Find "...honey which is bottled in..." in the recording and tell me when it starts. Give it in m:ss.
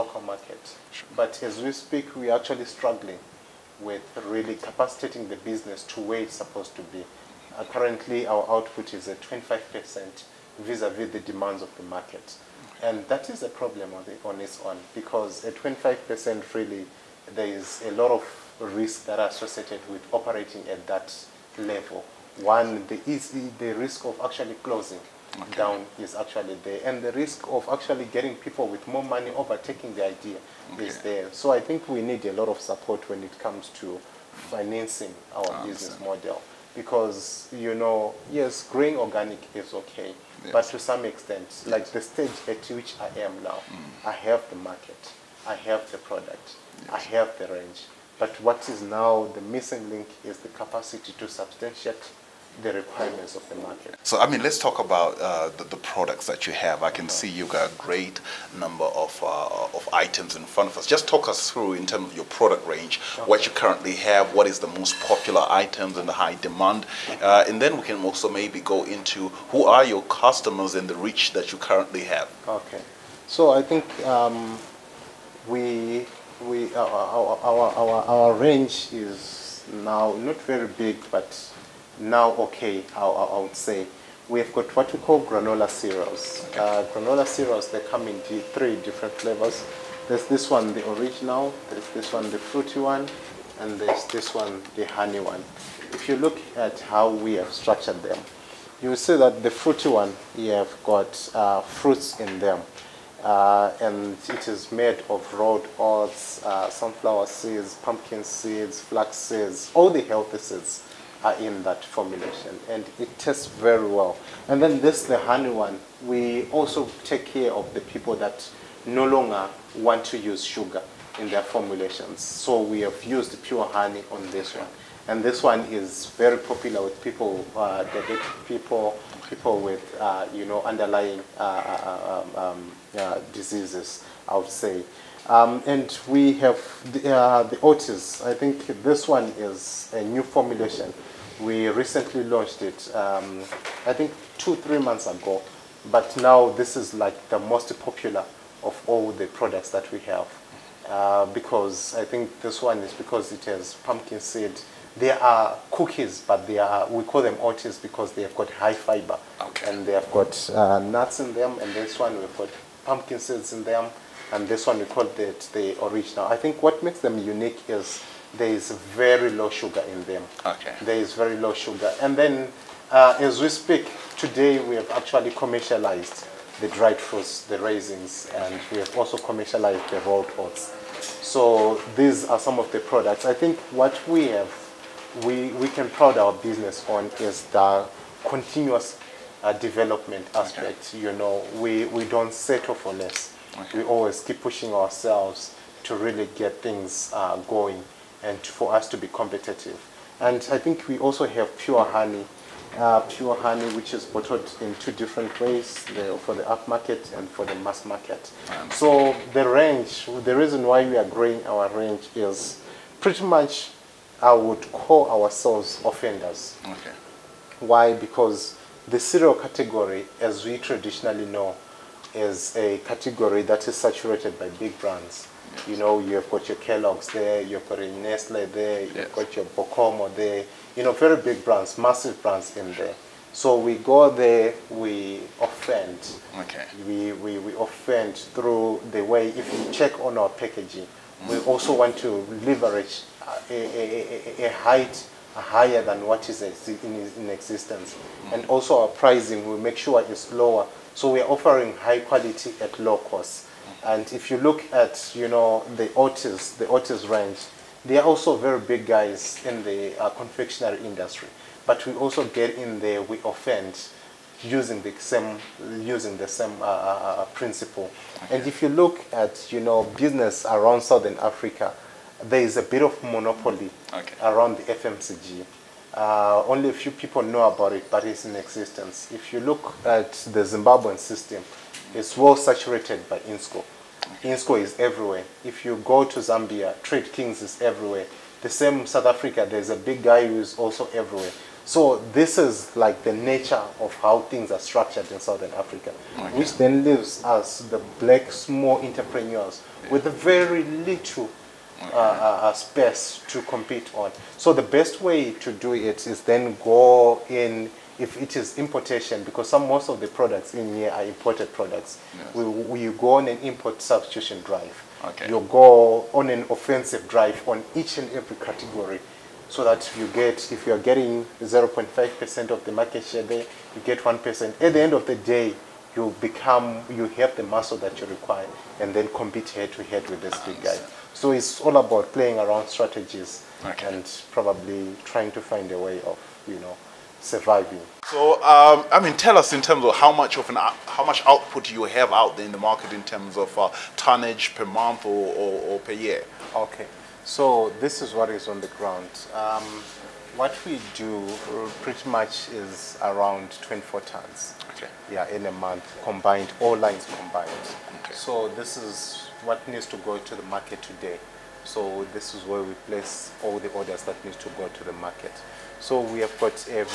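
3:23.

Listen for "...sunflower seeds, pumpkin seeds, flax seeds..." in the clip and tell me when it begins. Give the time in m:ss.
1:46.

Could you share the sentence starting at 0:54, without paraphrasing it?
So, I mean, let's talk about uh, the, the, products that you have.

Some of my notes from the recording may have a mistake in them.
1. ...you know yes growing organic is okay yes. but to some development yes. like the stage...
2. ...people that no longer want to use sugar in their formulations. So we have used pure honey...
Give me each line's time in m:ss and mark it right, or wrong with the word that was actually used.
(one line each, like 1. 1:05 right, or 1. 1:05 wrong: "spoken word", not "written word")
1. 0:37 wrong: "extent", not "development"
2. 1:57 right.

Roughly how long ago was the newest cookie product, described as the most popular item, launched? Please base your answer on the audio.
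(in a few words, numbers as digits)
2 to 3 months.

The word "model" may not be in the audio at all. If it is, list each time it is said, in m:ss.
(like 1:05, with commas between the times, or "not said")
0:35.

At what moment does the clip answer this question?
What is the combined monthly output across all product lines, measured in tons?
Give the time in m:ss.
5:53.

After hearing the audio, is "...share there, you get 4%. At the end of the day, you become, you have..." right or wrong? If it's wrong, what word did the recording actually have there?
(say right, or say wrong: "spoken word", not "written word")
wrong: "1", not "4".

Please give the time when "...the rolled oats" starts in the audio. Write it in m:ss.
2:59.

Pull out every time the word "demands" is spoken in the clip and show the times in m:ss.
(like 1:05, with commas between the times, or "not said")
0:11, 1:06.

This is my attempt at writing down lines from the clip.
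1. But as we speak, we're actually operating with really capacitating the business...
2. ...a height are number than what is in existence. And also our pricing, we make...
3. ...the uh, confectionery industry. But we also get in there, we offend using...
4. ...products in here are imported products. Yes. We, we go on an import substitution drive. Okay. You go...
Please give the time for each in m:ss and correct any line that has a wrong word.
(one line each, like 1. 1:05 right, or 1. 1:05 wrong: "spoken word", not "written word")
1. 0:01 wrong: "struggling", not "operating"
2. 4:04 wrong: "higher", not "number"
3. 4:19 right
4. 5:10 right.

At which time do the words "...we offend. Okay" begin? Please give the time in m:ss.
3:54.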